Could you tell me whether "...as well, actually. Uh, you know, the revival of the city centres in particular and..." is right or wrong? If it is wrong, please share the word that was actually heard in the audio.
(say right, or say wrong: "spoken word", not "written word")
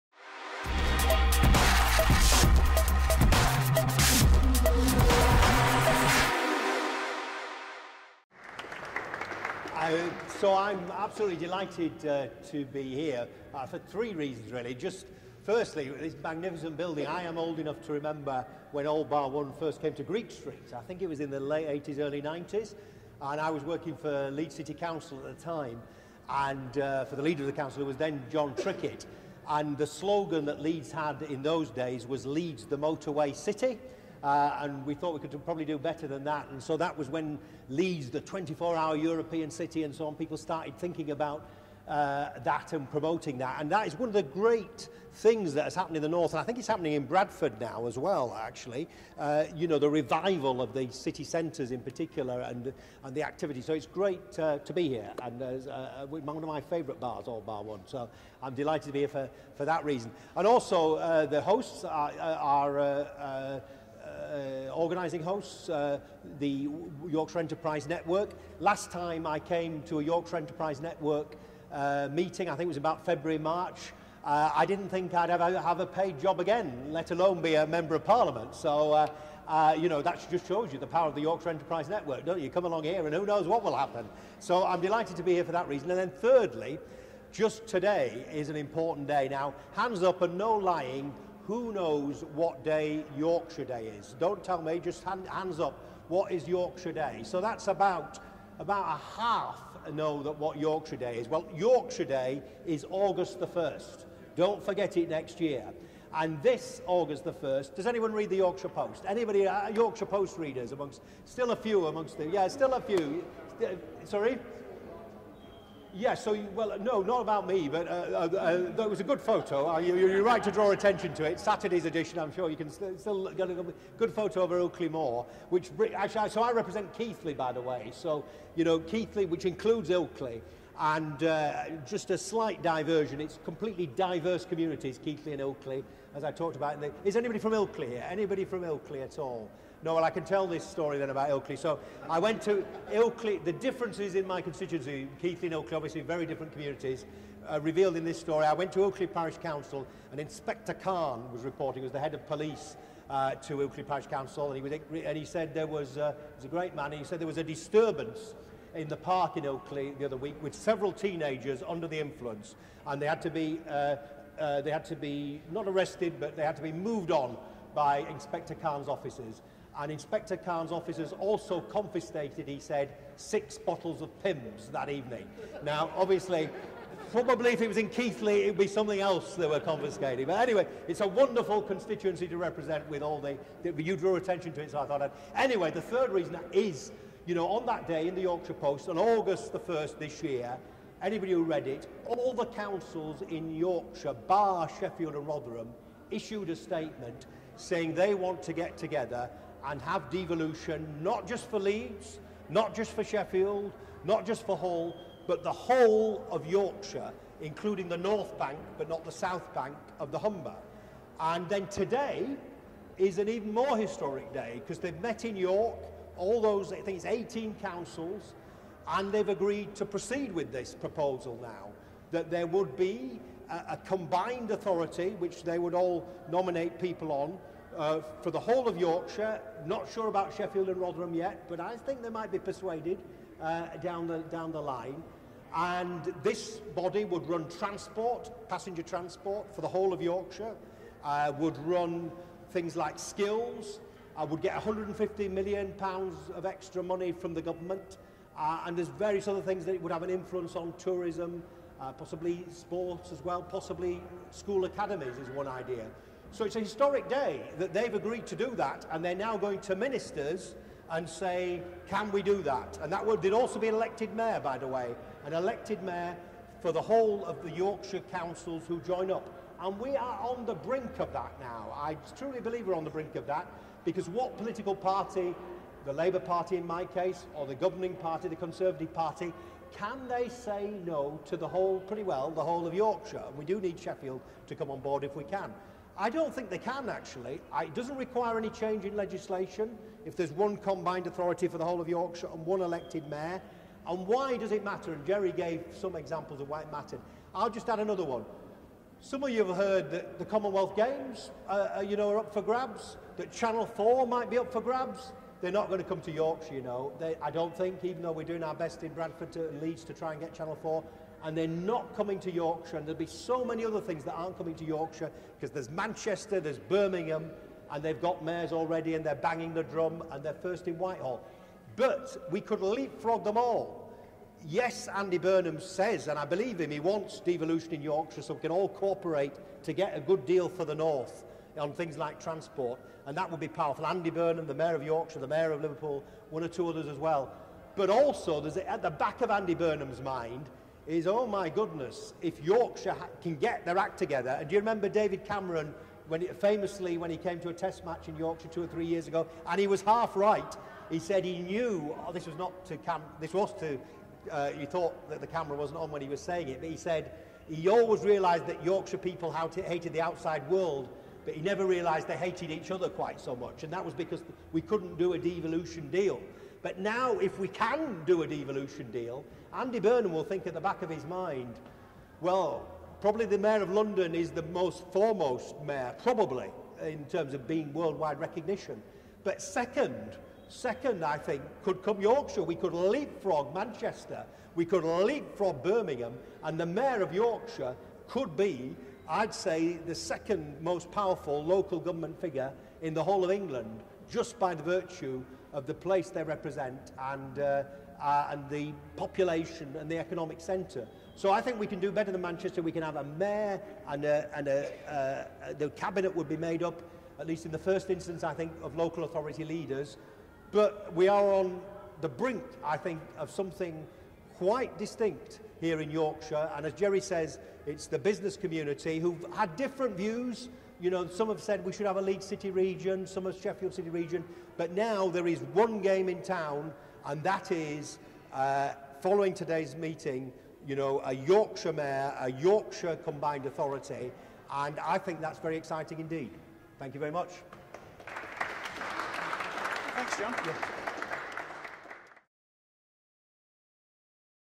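right.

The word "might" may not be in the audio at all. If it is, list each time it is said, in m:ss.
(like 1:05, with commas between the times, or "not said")
3:52, 5:04.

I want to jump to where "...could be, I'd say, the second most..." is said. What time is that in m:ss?
6:28.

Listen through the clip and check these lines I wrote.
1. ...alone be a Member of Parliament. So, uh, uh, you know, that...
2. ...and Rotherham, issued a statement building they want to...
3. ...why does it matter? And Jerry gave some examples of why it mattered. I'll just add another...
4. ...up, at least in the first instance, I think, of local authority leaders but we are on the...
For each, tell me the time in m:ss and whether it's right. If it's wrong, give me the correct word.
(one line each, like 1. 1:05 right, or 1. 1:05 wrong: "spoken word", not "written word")
1. 1:17 right
2. 3:15 wrong: "saying", not "building"
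3. 4:54 right
4. 6:46 right.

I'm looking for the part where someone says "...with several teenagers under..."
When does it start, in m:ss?
2:40.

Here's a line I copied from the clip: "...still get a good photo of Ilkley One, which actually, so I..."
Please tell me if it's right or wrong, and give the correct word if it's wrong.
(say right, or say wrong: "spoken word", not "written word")
wrong: "Moor", not "One".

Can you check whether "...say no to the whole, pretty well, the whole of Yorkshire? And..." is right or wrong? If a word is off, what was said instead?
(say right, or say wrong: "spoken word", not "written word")
right.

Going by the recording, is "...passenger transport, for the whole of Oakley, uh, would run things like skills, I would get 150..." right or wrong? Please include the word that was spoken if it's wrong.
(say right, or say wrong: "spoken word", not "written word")
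wrong: "Yorkshire", not "Oakley".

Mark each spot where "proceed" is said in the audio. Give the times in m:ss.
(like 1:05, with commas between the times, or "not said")
3:39.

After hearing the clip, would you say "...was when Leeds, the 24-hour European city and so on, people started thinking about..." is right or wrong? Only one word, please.
right.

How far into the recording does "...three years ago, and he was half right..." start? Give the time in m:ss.
5:48.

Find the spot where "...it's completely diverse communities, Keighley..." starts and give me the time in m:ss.
2:13.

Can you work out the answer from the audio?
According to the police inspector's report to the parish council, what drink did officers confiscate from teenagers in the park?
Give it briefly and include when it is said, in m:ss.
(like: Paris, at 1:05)
Pimm's, at 2:54.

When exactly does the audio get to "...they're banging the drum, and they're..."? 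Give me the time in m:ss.
5:19.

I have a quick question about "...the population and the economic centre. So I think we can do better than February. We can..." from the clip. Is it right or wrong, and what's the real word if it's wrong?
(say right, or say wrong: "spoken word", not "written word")
wrong: "Manchester", not "February".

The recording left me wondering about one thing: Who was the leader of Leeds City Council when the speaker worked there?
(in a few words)
Jon Trickett.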